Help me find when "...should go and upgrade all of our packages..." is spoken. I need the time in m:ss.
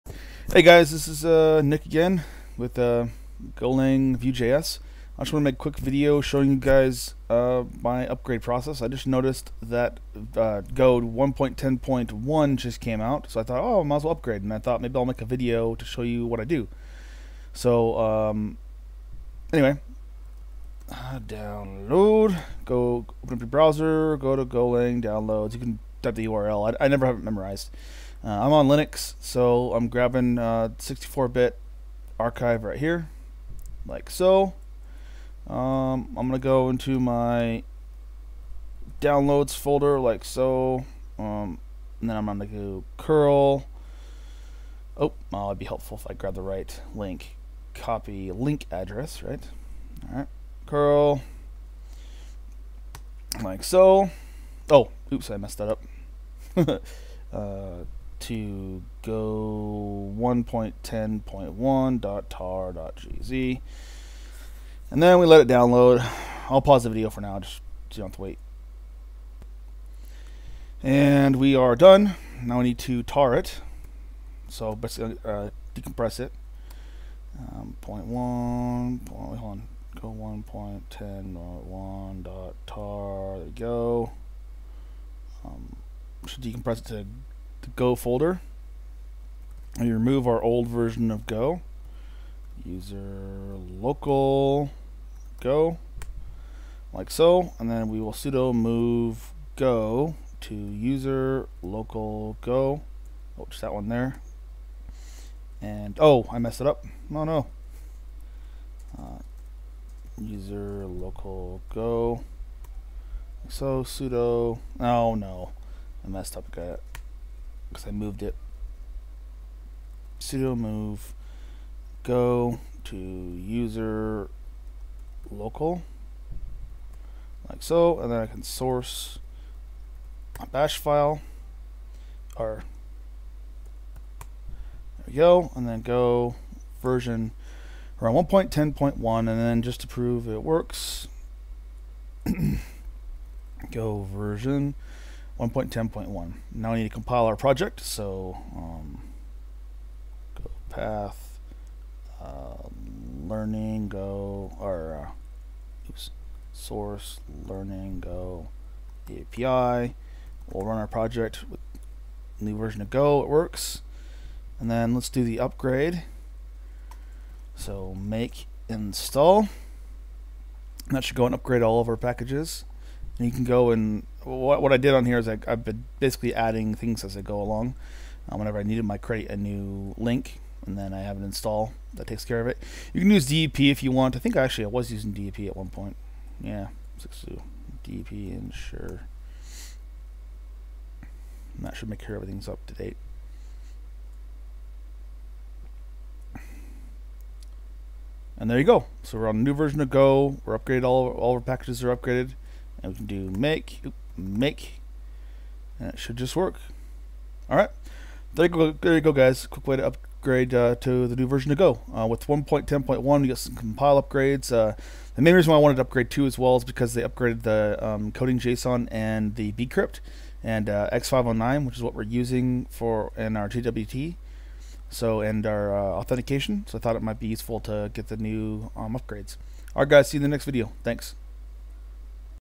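2:51.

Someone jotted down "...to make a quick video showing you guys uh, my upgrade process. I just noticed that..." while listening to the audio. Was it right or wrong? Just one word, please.
right.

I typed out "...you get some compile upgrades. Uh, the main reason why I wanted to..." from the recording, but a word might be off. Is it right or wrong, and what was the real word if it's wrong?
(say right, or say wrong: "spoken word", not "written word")
right.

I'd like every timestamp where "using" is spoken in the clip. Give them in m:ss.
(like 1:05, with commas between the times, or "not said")
3:04, 3:42.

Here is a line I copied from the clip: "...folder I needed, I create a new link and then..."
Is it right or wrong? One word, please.
wrong.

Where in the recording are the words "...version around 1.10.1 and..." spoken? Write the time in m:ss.
2:16.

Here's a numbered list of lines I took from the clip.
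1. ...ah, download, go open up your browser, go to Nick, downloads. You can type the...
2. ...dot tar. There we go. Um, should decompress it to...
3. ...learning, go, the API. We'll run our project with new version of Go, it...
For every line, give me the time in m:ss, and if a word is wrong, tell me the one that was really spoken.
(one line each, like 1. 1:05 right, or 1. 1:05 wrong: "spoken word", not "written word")
1. 0:20 wrong: "Golang", not "Nick"
2. 1:22 right
3. 2:37 right.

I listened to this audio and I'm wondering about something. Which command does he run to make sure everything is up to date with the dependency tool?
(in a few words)
DEP ensure.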